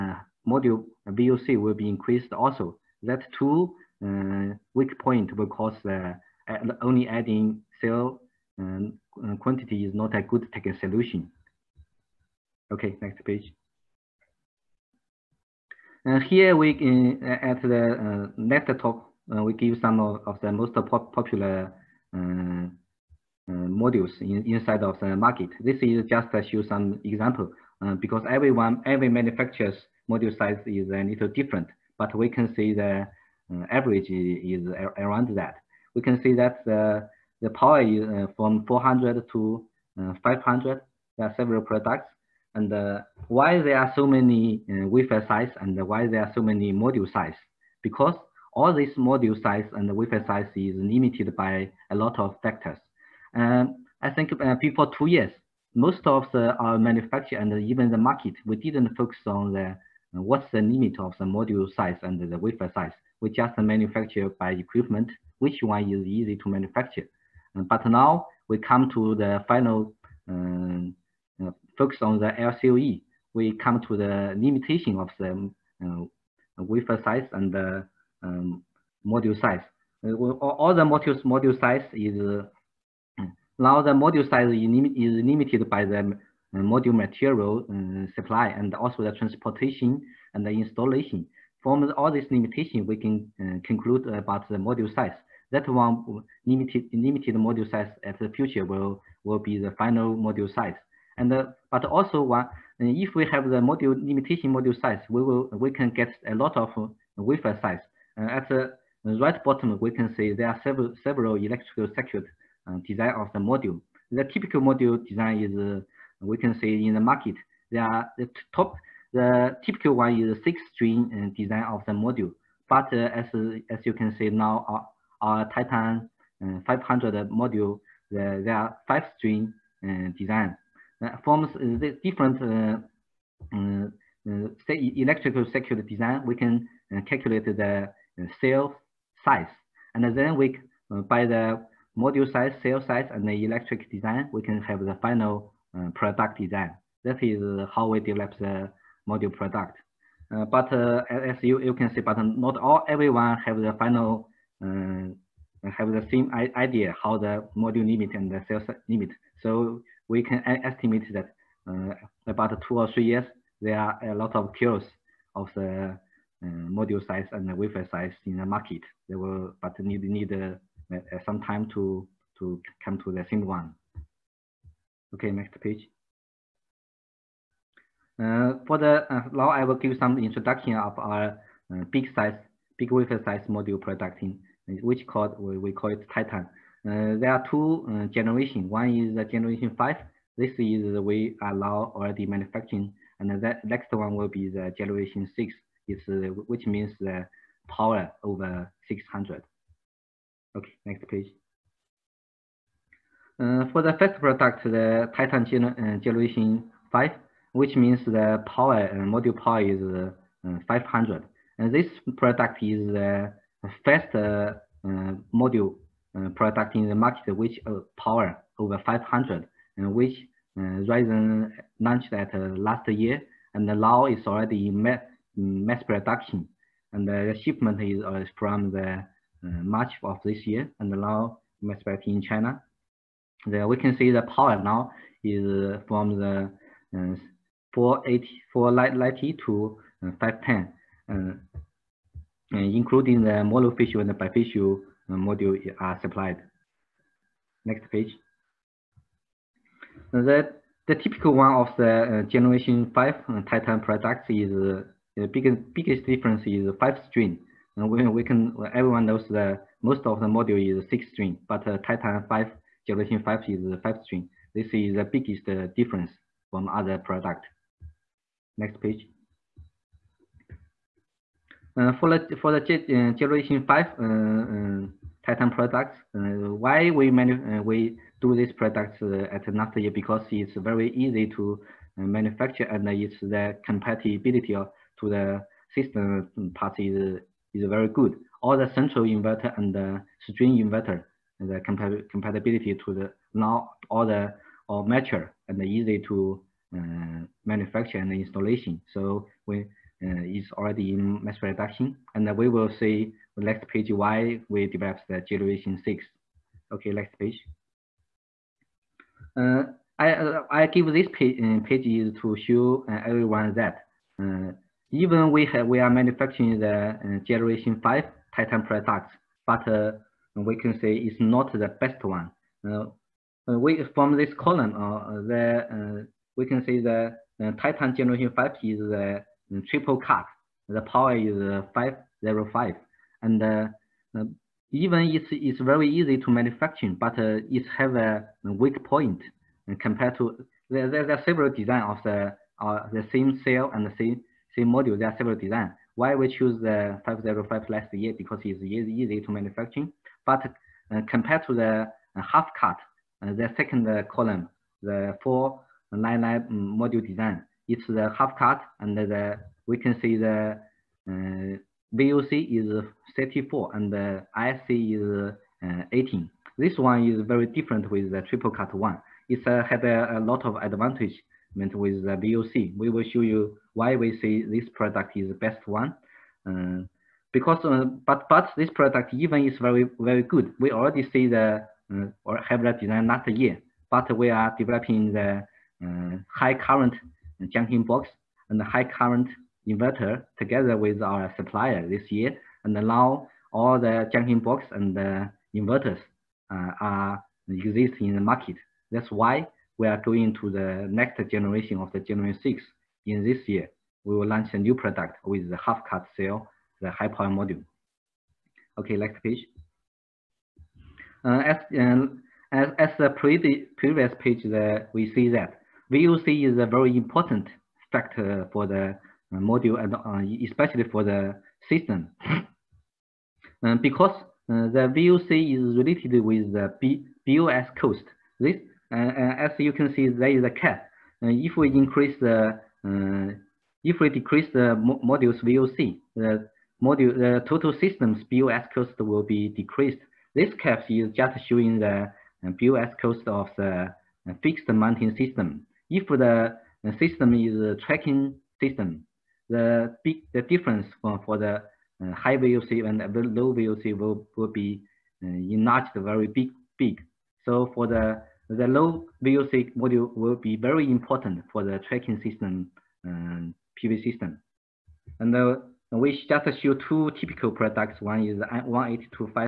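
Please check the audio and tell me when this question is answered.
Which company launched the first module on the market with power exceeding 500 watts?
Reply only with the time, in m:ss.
3:40.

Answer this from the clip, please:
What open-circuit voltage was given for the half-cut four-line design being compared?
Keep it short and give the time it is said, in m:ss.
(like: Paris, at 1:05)
34, at 6:03.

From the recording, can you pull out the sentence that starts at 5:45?
Why we choose the 505 last year?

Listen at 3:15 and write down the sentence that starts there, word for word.
It's uh, which means the power over 600.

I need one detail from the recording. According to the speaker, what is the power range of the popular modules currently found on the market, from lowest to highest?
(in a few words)
400 to 500.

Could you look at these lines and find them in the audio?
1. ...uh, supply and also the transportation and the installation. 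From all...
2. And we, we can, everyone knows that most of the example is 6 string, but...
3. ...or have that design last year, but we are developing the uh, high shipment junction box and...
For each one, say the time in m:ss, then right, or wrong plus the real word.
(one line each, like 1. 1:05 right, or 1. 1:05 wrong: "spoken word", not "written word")
1. 1:27 right
2. 4:17 wrong: "module", not "example"
3. 6:22 wrong: "current", not "shipment".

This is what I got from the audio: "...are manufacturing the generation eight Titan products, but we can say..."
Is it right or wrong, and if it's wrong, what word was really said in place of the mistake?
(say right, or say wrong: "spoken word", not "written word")
wrong: "five", not "eight".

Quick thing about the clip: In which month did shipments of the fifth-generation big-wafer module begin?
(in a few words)
March.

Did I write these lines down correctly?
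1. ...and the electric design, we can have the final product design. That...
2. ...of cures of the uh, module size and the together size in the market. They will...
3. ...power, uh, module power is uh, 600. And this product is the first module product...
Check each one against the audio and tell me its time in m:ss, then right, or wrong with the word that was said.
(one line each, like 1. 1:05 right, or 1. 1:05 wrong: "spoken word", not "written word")
1. 2:23 right
2. 2:44 wrong: "wafer", not "together"
3. 3:28 wrong: "500", not "600".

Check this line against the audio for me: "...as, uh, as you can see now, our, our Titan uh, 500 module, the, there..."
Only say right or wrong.
right.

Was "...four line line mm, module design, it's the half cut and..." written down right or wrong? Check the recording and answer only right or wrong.
right.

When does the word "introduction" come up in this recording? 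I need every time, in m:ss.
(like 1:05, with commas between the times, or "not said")
3:00.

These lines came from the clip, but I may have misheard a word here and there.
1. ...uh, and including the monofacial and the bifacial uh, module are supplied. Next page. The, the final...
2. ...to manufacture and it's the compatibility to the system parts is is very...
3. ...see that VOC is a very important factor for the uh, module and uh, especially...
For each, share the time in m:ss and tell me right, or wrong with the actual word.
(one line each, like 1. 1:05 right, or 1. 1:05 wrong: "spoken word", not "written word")
1. 4:01 wrong: "typical", not "final"
2. 4:41 right
3. 6:55 right.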